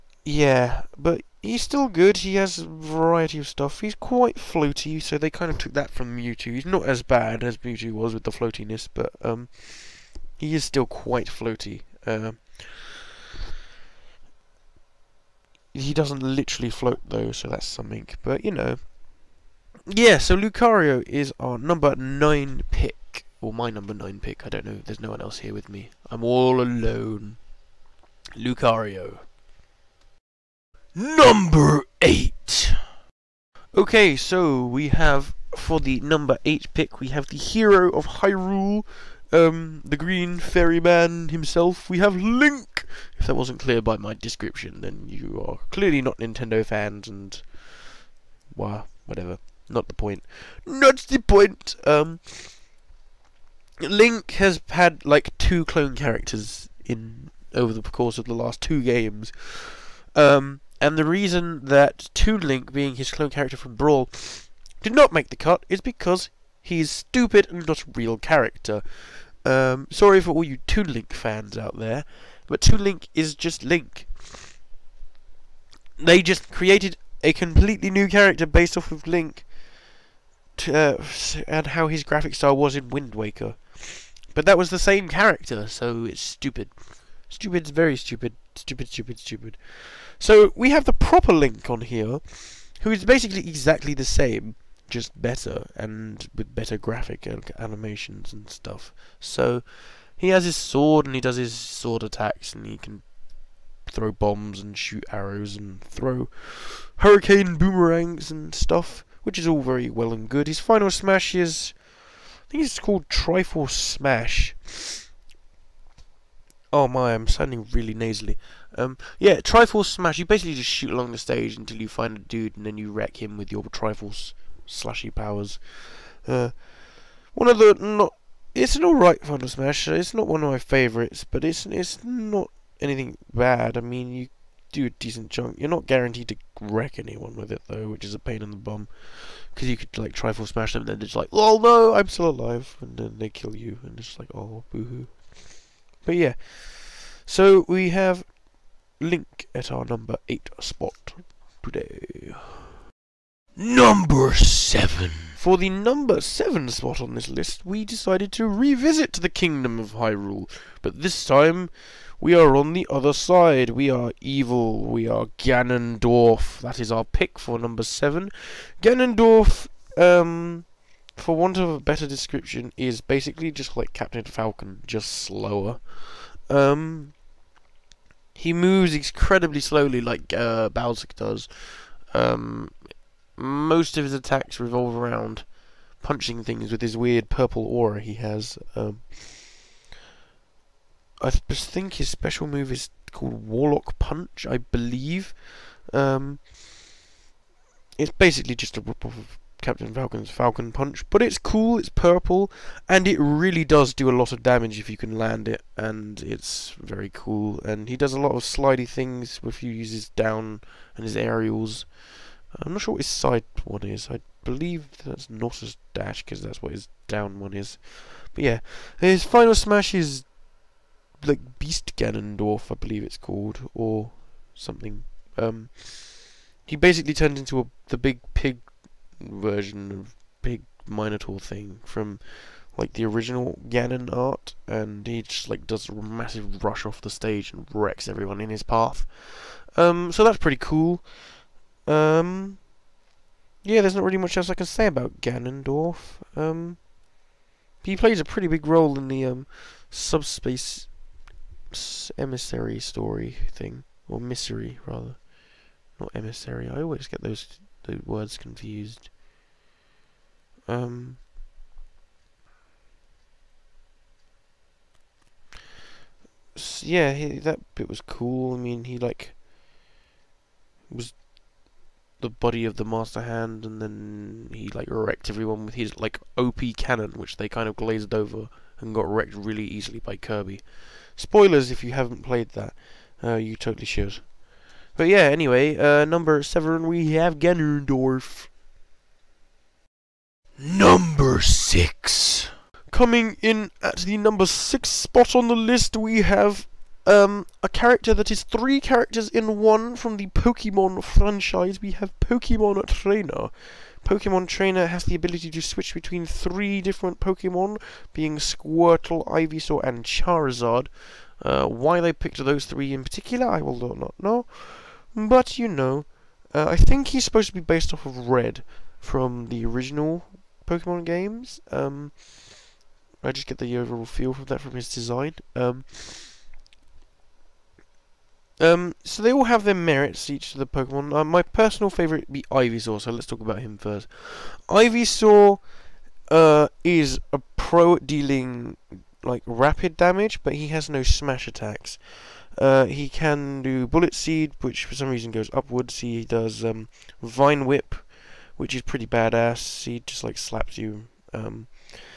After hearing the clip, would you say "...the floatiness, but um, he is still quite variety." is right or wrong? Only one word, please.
wrong.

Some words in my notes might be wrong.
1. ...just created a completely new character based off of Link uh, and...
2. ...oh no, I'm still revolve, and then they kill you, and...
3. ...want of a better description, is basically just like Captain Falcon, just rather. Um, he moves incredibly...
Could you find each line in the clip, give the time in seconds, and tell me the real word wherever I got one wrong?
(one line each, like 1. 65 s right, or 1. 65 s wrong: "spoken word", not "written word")
1. 76 s right
2. 141 s wrong: "alive", not "revolve"
3. 171 s wrong: "slower", not "rather".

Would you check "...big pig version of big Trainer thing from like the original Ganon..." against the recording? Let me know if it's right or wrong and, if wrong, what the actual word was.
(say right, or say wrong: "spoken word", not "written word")
wrong: "Minotaur", not "Trainer".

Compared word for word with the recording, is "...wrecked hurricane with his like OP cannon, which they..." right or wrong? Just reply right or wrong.
wrong.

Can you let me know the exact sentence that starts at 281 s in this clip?
Spoilers if you haven't played that.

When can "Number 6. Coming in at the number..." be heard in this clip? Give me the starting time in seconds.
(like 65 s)
290 s.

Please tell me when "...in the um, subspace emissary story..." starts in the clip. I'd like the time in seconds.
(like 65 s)
248 s.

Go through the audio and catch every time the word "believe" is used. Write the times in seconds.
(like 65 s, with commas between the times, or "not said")
194 s, 214 s, 222 s.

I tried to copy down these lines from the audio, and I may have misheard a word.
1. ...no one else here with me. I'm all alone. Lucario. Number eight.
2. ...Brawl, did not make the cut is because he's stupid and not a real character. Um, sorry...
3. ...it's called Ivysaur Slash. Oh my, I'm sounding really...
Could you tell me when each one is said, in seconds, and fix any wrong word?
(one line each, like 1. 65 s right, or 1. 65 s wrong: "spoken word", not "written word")
1. 24 s right
2. 63 s right
3. 112 s wrong: "Triforce", not "Ivysaur".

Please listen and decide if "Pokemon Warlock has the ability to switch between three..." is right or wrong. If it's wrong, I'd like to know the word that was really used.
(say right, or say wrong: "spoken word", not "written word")
wrong: "Trainer", not "Warlock".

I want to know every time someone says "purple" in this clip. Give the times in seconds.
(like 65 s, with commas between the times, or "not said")
187 s, 201 s.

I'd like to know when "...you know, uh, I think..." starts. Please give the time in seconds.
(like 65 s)
315 s.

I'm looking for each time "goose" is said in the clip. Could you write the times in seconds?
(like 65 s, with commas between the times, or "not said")
not said.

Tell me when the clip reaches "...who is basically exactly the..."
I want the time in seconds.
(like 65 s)
92 s.